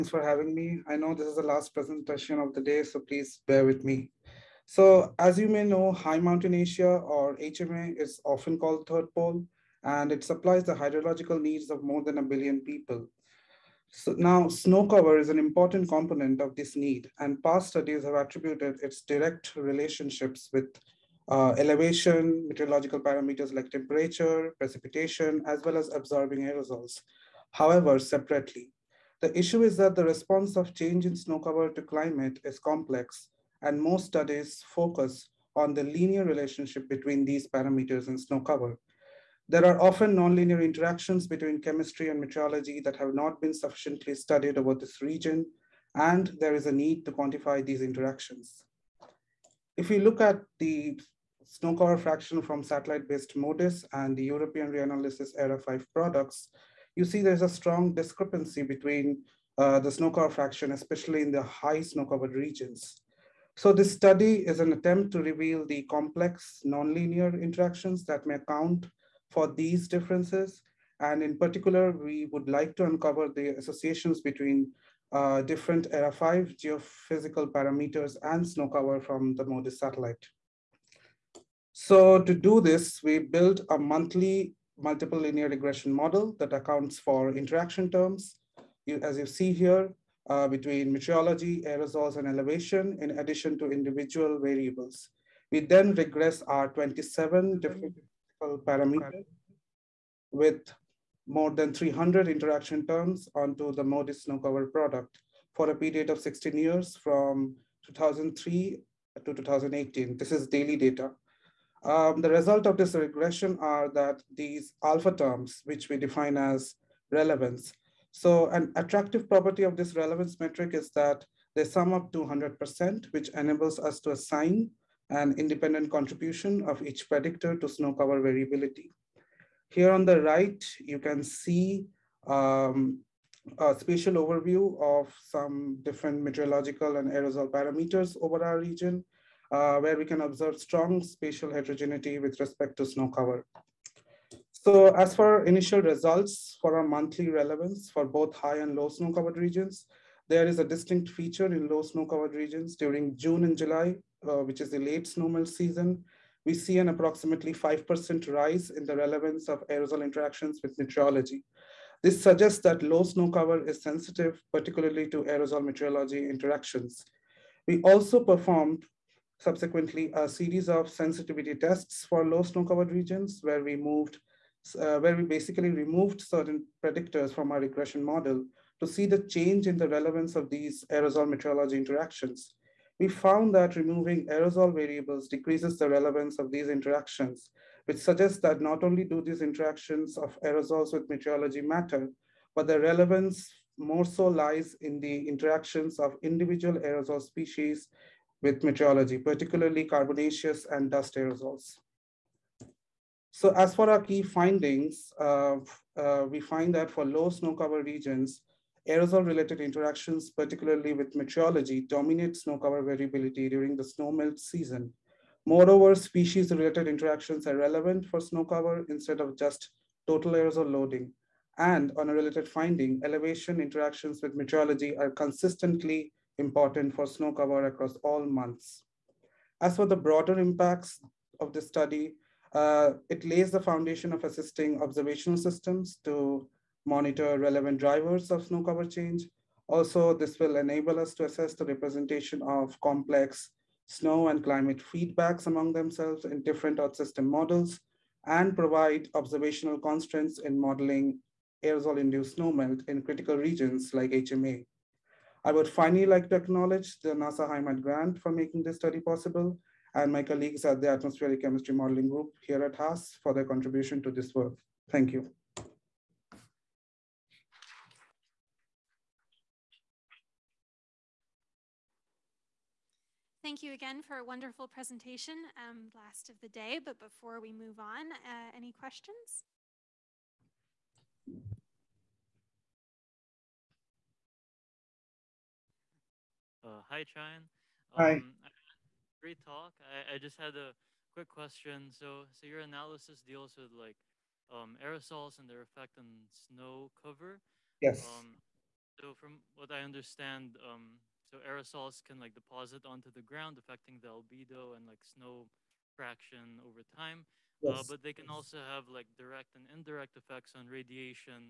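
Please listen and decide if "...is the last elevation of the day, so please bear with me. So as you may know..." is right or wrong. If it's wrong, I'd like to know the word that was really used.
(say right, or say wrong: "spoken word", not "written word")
wrong: "presentation", not "elevation".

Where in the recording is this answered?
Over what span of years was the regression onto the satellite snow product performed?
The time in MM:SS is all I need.
01:47.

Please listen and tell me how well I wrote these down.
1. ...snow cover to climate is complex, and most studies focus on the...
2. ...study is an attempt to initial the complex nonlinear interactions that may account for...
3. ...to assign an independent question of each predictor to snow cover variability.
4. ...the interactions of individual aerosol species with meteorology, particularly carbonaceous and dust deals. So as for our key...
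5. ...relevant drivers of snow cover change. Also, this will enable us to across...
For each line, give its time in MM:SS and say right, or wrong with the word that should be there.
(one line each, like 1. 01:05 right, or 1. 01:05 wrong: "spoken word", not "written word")
1. 00:31 right
2. 01:03 wrong: "reveal", not "initial"
3. 02:04 wrong: "contribution", not "question"
4. 03:15 wrong: "aerosols", not "deals"
5. 03:57 wrong: "assess", not "across".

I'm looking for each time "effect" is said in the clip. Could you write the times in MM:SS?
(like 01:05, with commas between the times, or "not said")
04:55, 05:10.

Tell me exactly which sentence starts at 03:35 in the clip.
Moreover, species-related interactions are relevant for snow cover instead of just total aerosol loading.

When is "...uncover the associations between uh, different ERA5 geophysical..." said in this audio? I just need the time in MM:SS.
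01:12.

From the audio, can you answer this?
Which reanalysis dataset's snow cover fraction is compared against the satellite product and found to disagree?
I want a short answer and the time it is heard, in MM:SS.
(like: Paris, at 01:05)
ERA5, at 00:54.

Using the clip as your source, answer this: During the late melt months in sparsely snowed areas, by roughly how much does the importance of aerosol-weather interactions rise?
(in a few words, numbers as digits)
5%.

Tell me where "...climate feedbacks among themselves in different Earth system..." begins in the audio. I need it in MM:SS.
04:04.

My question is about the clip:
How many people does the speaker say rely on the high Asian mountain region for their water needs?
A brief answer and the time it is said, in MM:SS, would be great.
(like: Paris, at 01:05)
more than a billion, at 00:11.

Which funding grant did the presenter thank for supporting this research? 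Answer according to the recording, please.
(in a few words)
NASA HIMAT grant.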